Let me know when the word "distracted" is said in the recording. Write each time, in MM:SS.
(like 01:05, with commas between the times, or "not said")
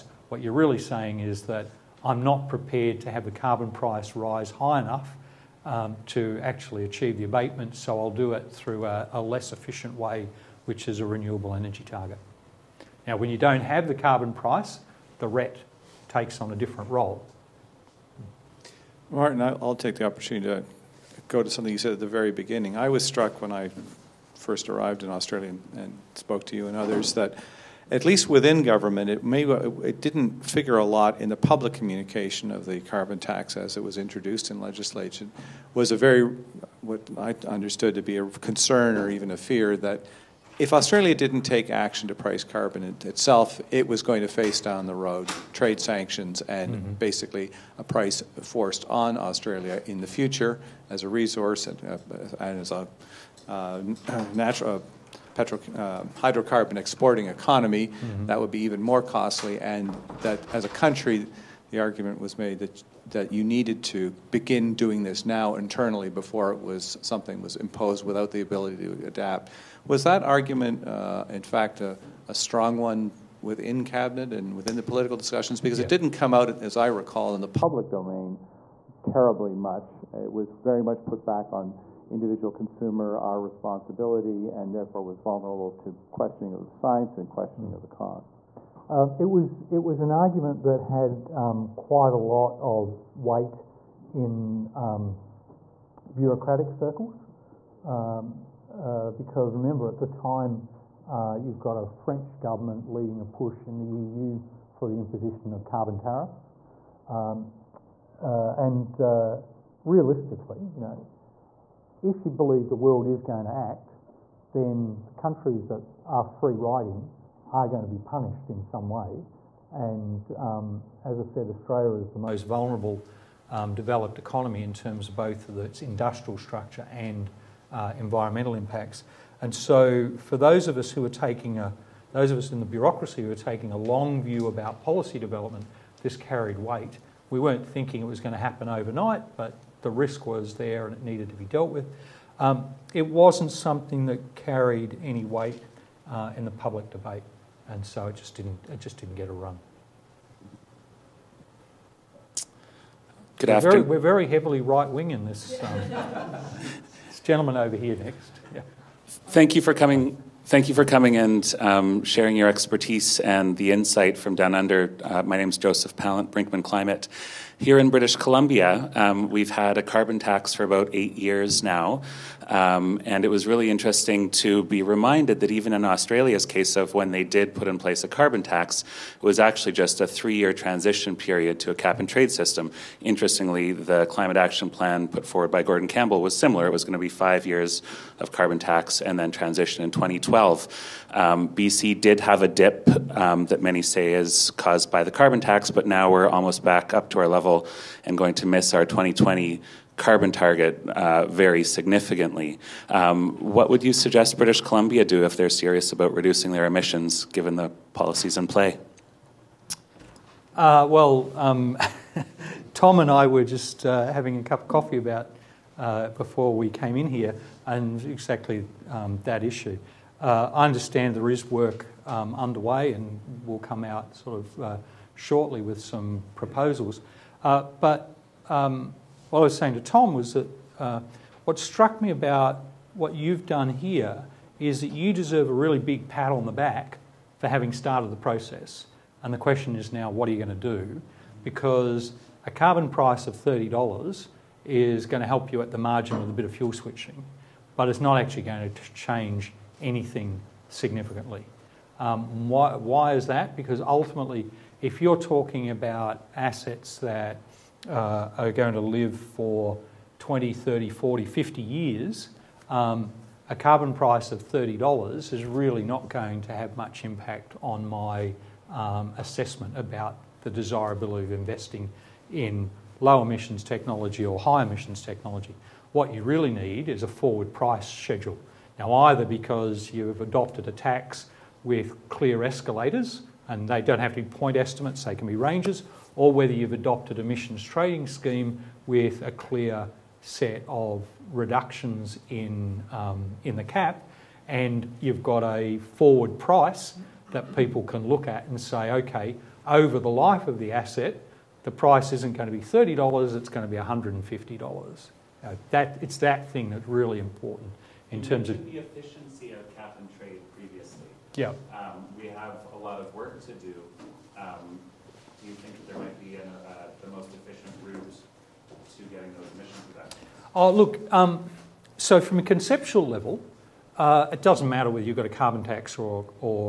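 not said.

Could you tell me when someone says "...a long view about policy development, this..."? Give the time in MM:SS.
02:13.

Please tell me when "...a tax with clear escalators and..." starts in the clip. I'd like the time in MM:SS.
04:40.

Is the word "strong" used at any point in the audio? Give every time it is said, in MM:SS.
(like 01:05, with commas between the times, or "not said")
01:12.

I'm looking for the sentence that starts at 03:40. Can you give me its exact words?
Uh, I understand there is work um, underway, and will come out sort of uh, shortly with some proposals.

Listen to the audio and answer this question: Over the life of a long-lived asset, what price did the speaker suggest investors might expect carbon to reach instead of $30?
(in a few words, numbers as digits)
$150.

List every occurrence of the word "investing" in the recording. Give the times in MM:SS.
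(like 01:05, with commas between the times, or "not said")
04:31.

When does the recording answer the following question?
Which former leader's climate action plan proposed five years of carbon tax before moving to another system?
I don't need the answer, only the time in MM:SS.
03:05.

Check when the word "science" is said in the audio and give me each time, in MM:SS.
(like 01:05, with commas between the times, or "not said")
01:26.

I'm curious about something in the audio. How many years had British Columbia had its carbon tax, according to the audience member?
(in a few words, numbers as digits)
8.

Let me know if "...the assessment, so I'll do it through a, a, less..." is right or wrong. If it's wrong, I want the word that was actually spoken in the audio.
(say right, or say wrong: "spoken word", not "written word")
wrong: "abatement", not "assessment".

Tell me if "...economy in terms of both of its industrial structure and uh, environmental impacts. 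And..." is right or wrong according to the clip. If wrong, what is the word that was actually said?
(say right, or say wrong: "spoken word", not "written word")
right.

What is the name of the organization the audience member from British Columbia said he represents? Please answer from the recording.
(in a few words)
Brinkman Climate.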